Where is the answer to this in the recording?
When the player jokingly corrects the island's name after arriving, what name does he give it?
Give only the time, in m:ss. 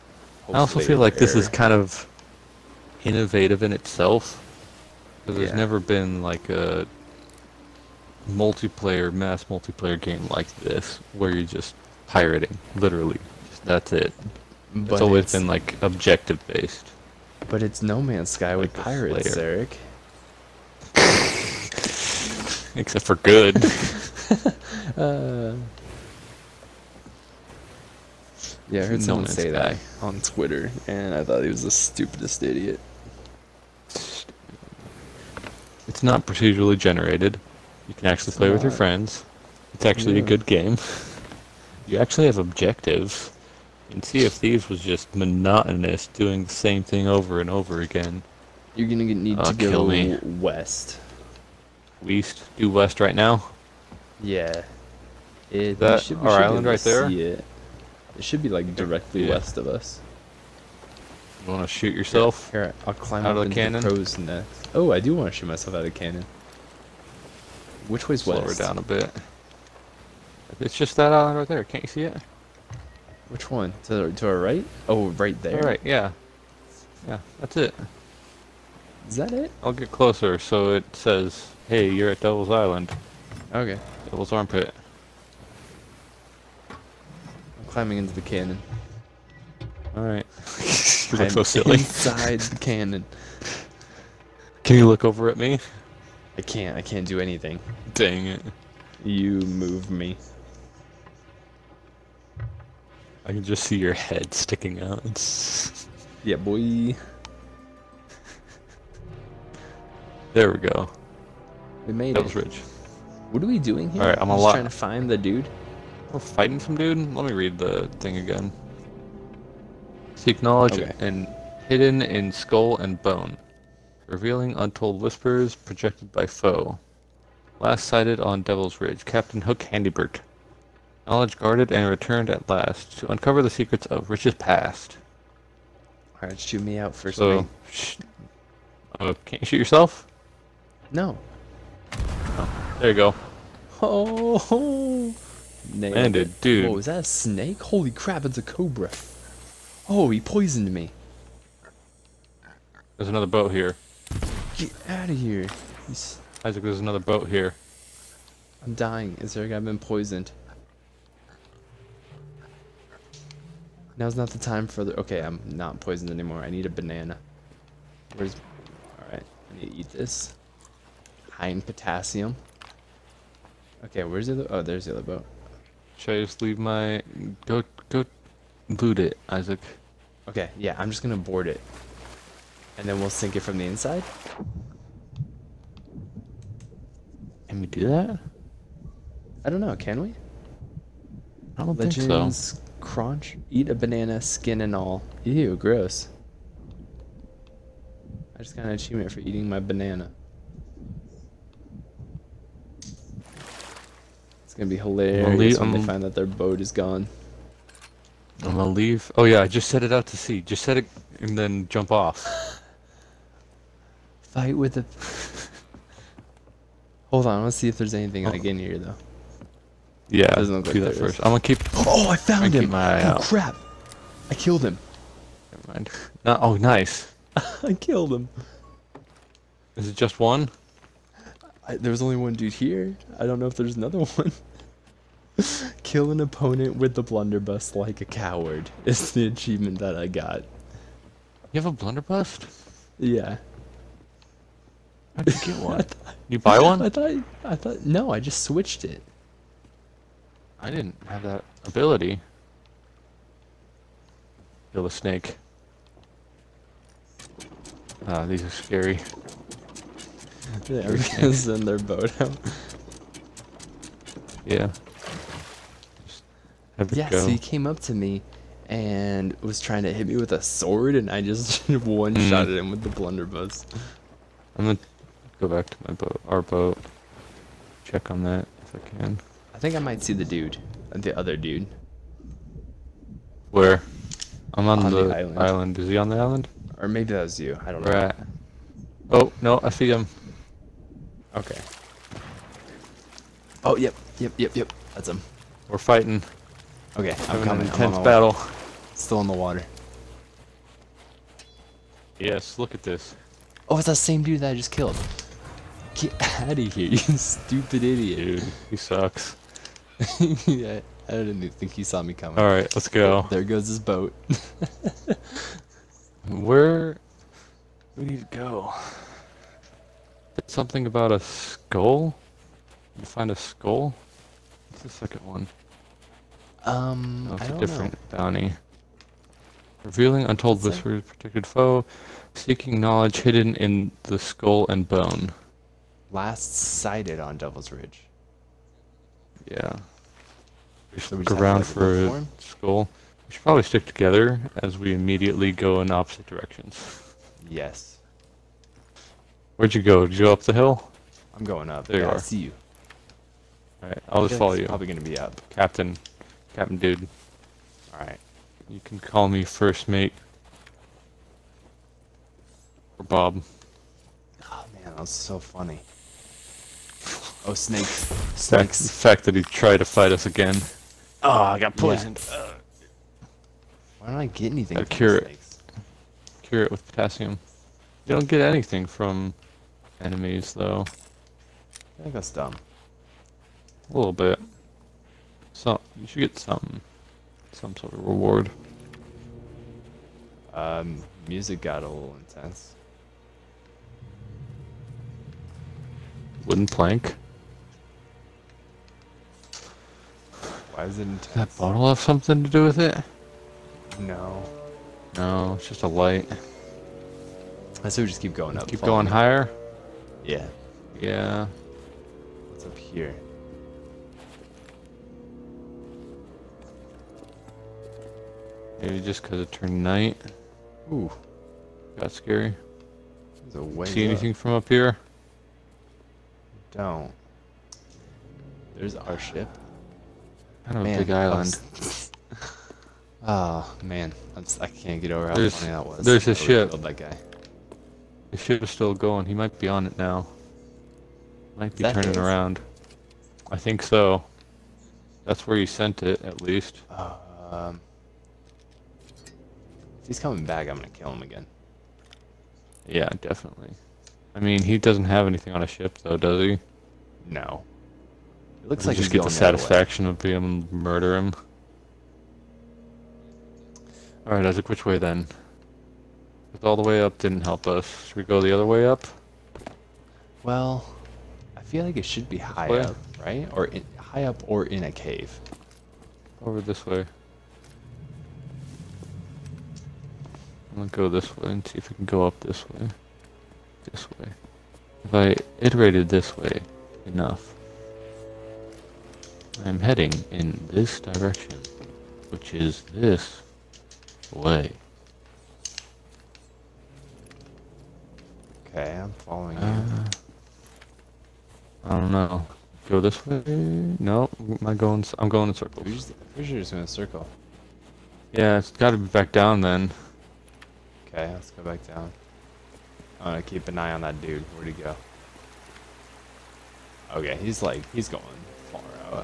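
1:24.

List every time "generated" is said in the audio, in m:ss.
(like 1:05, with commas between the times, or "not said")
0:36.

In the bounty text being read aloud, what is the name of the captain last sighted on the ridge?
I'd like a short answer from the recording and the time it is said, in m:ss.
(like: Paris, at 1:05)
Captain Hook Handybert, at 2:09.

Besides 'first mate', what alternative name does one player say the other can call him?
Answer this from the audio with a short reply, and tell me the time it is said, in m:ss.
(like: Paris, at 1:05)
Bob, at 6:03.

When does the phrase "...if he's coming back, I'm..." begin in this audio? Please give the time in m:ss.
7:30.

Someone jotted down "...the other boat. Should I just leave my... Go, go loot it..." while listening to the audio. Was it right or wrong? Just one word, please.
right.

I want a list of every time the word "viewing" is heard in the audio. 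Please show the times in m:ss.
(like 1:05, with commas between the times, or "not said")
not said.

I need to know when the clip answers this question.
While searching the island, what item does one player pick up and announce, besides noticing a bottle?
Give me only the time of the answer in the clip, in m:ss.
6:36.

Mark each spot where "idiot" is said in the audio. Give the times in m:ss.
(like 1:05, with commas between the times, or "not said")
0:32, 5:07.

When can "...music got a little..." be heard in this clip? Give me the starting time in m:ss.
6:31.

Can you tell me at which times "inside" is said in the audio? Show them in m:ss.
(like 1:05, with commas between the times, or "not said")
1:31, 3:03.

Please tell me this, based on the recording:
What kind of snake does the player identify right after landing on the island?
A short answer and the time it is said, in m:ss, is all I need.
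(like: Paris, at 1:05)
Cobra, at 2:28.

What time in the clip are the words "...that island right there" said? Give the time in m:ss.
1:10.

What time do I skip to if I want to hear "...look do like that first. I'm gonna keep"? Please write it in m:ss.
3:40.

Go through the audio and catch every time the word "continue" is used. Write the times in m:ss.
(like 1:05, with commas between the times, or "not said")
not said.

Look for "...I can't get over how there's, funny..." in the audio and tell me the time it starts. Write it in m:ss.
7:14.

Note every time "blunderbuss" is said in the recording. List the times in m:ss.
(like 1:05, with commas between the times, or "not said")
3:57, 4:01, 4:32.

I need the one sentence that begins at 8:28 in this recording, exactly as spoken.
Yeah, it's got to be back down then.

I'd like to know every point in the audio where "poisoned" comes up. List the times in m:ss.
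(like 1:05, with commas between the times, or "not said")
2:30, 2:39, 2:45, 6:11.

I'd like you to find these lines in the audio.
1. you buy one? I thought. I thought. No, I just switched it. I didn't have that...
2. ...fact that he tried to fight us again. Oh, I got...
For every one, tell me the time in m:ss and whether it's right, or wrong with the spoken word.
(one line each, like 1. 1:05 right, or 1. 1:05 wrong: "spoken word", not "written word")
1. 4:06 right
2. 6:08 right.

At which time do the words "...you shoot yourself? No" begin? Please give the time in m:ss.
2:19.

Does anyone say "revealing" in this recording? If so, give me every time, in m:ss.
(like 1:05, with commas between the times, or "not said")
2:04, 5:29.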